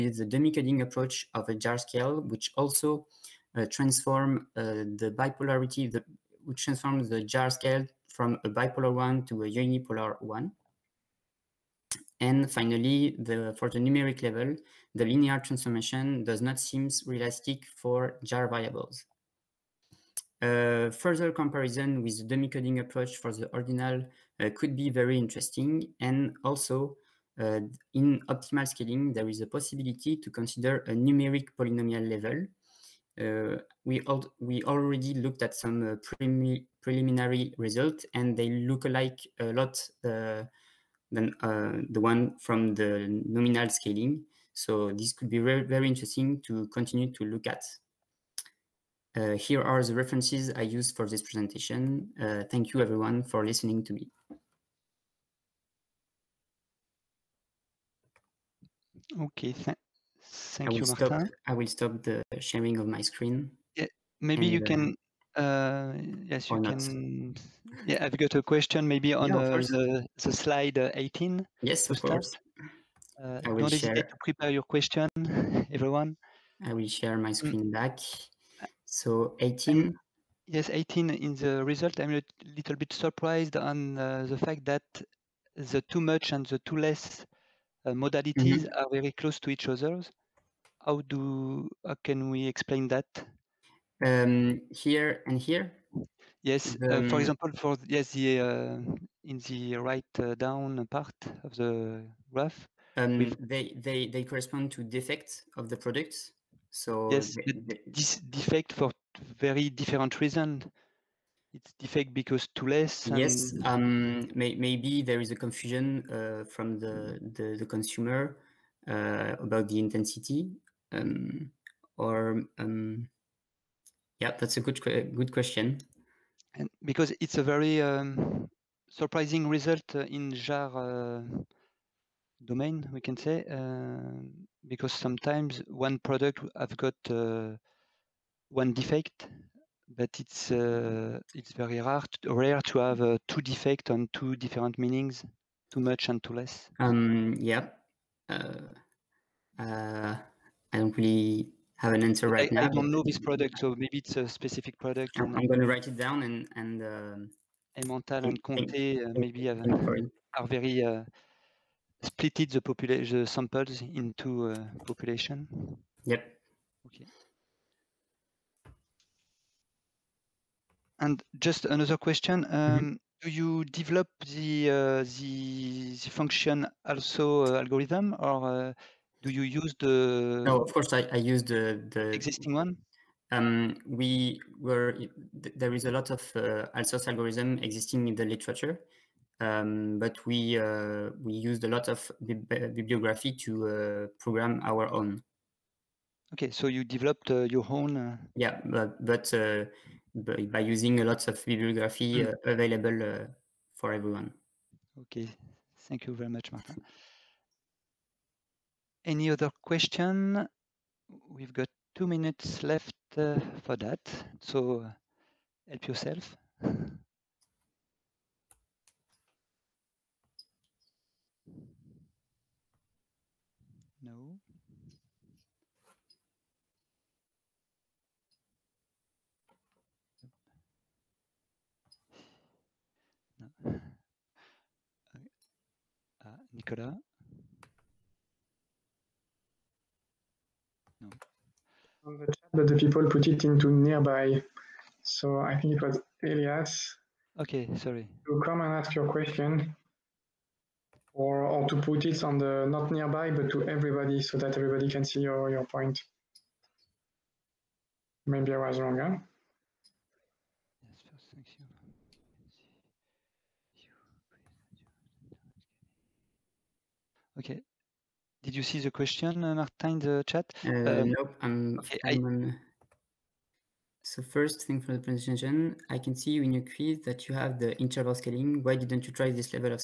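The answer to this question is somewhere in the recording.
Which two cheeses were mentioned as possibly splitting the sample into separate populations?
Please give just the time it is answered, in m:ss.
2:37.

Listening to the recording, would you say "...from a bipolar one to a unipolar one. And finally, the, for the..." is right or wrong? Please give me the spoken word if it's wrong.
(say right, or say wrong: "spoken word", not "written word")
right.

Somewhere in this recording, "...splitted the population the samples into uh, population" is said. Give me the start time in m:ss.
2:42.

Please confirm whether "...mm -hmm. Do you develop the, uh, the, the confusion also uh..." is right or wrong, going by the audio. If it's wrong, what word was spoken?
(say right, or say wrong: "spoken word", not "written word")
wrong: "function", not "confusion".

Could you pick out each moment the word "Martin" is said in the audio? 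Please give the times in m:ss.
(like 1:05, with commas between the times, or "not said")
1:00, 3:26, 4:29.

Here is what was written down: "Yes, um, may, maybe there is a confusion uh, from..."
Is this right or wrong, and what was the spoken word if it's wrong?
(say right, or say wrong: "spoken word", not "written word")
right.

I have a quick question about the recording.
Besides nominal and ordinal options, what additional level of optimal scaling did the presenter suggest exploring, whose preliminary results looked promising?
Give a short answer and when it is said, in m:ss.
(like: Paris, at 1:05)
numeric polynomial level, at 0:30.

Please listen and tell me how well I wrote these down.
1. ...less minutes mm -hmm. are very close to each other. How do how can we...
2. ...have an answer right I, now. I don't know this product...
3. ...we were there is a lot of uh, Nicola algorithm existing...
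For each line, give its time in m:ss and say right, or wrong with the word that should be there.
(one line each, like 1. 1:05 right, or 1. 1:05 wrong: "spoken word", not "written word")
1. 1:26 wrong: "modalities", not "minutes"
2. 2:31 right
3. 3:03 wrong: "Alsos", not "Nicola".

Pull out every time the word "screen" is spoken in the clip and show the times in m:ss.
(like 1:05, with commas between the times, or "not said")
1:02, 1:17.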